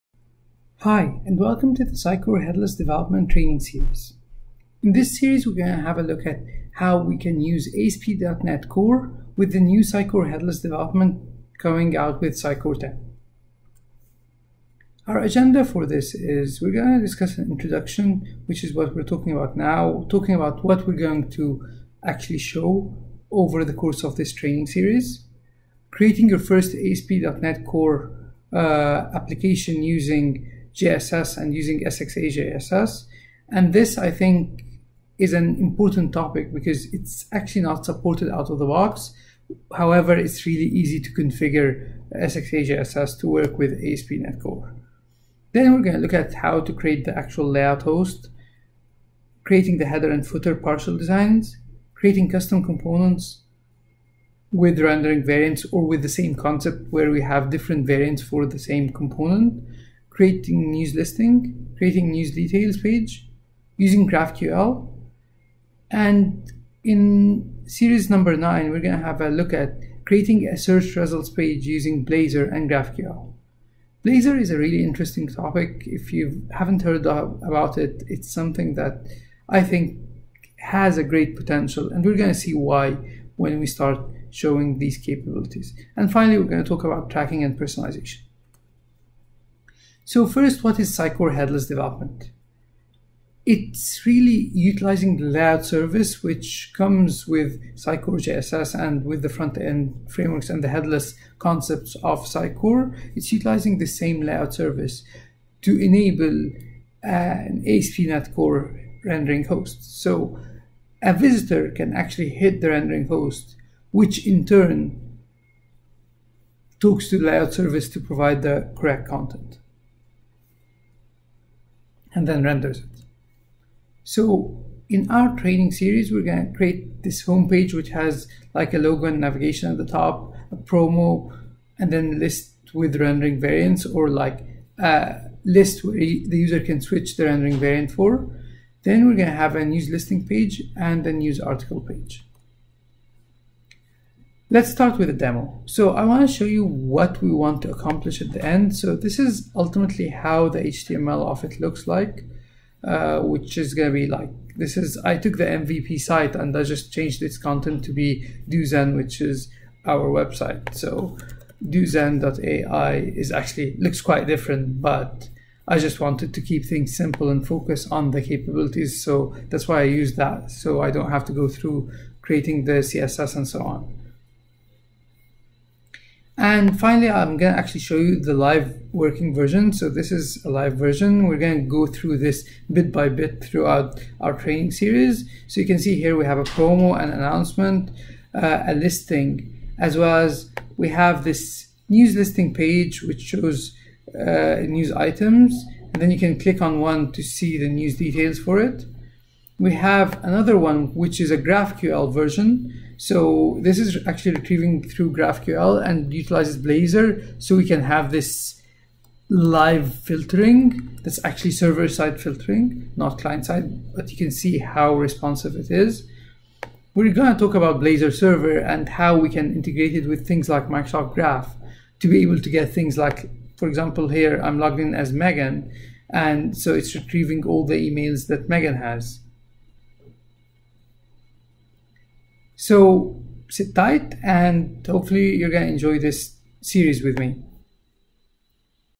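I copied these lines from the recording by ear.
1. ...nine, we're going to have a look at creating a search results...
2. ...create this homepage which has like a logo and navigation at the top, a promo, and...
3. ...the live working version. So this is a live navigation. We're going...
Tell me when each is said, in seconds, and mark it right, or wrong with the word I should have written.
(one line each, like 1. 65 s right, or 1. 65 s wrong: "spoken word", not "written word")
1. 68 s right
2. 126 s right
3. 178 s wrong: "version", not "navigation".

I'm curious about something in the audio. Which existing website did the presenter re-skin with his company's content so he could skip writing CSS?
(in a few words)
The MVP site.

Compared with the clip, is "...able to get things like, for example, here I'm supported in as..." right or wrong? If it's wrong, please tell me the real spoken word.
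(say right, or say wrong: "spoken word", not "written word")
wrong: "logged", not "supported".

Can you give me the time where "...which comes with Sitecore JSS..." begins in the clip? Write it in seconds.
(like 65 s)
96 s.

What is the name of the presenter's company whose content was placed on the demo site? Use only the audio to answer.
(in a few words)
Duzen.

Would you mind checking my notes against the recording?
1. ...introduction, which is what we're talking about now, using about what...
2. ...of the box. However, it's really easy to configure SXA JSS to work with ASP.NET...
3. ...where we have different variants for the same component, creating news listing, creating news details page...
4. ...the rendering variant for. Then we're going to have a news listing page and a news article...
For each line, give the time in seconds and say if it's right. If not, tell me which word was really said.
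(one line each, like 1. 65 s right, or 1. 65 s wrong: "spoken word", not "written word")
1. 17 s wrong: "talking", not "using"
2. 38 s right
3. 56 s right
4. 137 s right.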